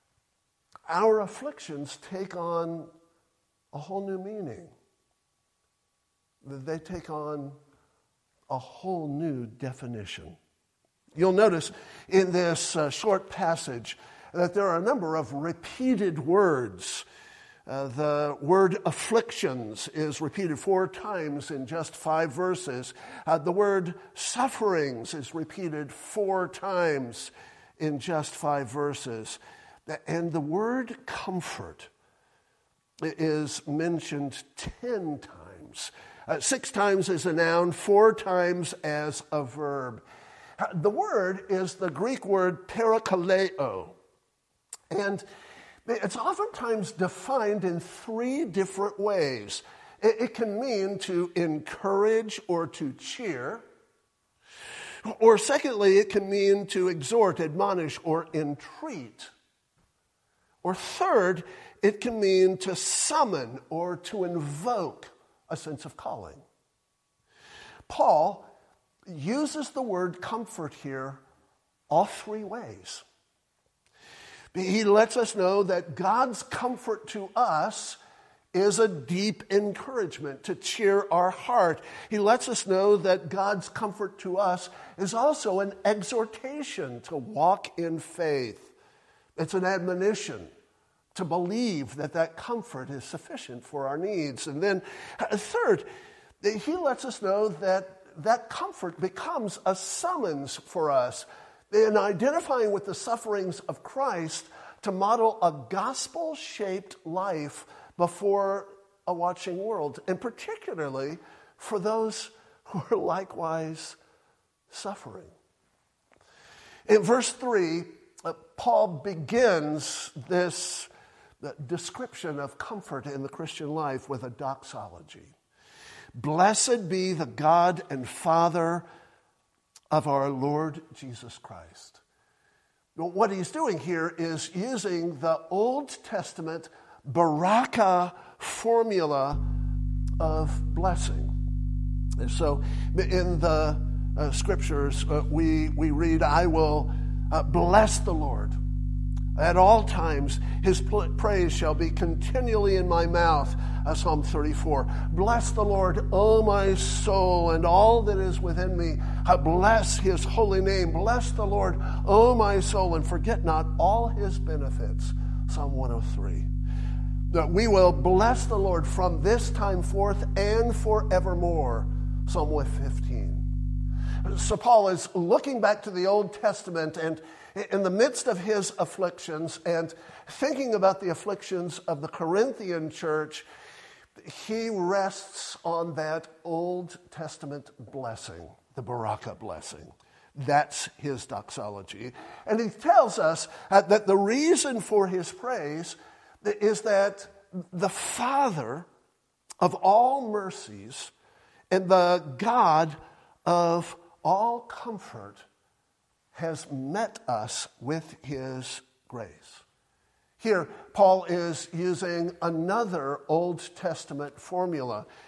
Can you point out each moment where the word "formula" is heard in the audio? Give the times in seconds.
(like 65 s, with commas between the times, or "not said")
138 s, 214 s.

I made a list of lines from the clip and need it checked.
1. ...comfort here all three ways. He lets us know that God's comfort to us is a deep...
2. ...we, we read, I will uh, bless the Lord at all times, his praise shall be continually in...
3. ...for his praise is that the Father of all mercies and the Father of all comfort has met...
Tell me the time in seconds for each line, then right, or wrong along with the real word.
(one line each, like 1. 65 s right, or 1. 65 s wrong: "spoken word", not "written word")
1. 70 s right
2. 145 s right
3. 194 s wrong: "God", not "Father".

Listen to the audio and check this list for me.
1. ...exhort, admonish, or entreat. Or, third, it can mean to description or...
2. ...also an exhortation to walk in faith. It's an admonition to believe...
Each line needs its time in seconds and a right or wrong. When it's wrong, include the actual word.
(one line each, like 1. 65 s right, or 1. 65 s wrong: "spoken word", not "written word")
1. 56 s wrong: "summon", not "description"
2. 85 s right.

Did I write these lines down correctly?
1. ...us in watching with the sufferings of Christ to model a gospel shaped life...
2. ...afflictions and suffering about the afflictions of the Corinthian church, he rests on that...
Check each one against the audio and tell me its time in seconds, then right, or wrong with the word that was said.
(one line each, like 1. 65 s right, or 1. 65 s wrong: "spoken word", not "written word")
1. 100 s wrong: "identifying", not "watching"
2. 178 s wrong: "thinking", not "suffering".